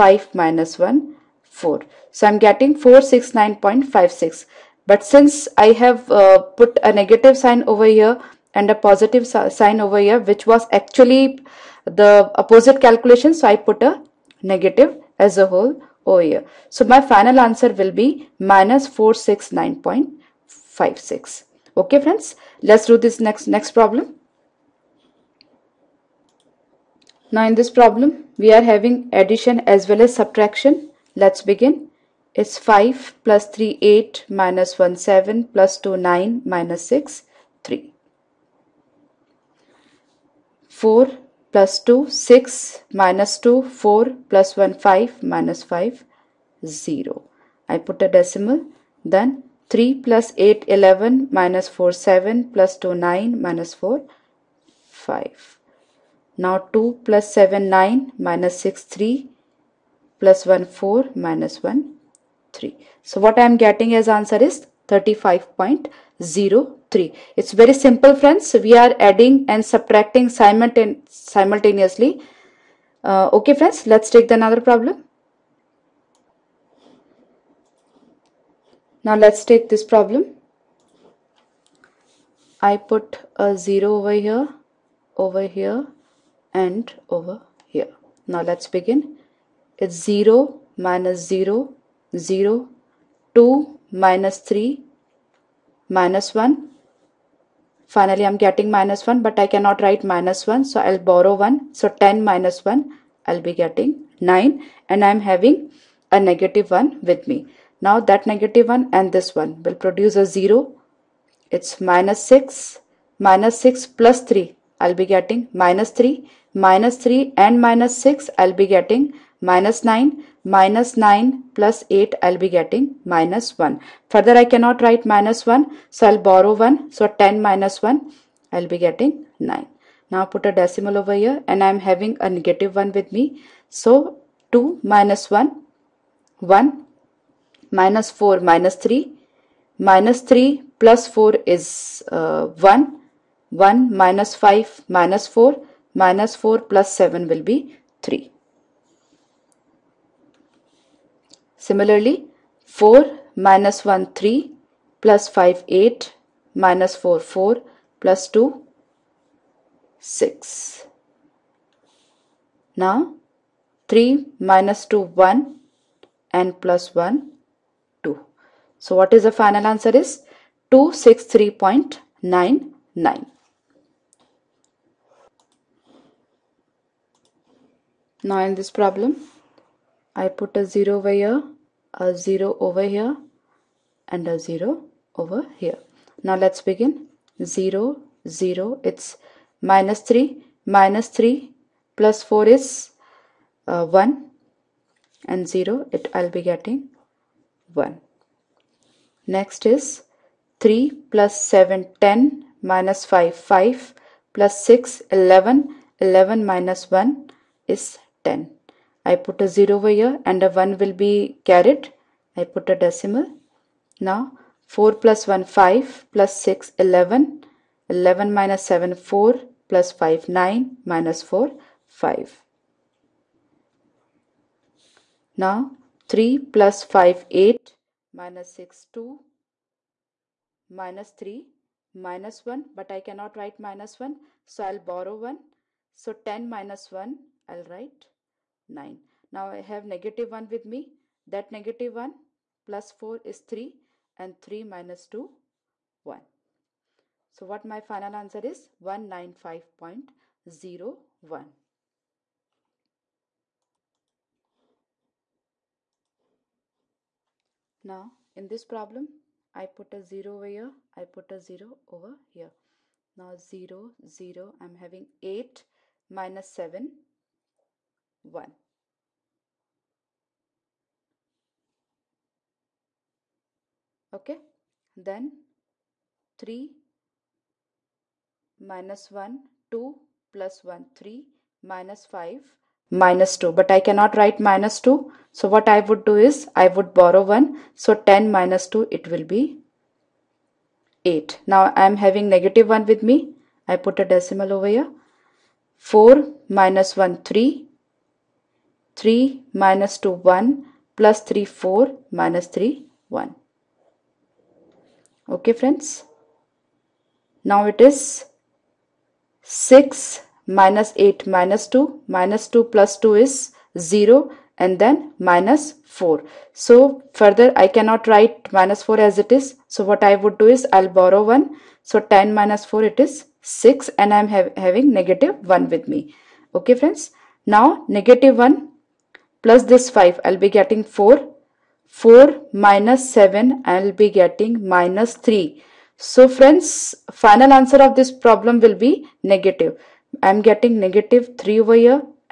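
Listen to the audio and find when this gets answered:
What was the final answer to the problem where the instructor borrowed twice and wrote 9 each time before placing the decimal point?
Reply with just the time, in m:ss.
2:50.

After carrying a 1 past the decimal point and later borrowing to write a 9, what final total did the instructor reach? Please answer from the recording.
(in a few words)
195.01.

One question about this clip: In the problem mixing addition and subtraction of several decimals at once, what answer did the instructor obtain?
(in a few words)
35.03.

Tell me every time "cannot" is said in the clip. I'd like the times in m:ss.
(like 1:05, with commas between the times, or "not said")
1:39, 2:04, 3:53, 4:43, 5:17.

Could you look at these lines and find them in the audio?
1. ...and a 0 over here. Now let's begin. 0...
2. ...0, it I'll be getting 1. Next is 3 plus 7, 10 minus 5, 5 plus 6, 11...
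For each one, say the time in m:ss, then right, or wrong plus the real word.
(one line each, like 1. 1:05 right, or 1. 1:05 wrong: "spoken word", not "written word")
1. 3:04 right
2. 3:15 right.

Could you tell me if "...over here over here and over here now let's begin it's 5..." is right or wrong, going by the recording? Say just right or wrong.
wrong.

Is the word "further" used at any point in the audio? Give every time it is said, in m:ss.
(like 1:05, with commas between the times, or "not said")
2:04, 5:17.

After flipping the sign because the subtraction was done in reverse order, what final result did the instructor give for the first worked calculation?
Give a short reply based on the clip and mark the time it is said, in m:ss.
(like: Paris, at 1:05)
-469.56, at 0:18.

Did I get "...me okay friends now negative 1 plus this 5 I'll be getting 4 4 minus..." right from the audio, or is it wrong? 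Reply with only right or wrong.
right.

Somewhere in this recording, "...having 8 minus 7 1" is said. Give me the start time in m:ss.
4:24.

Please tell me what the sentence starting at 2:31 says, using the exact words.
Similarly, 4 minus 1 3 plus 5 8 minus 4 4 plus 2 6.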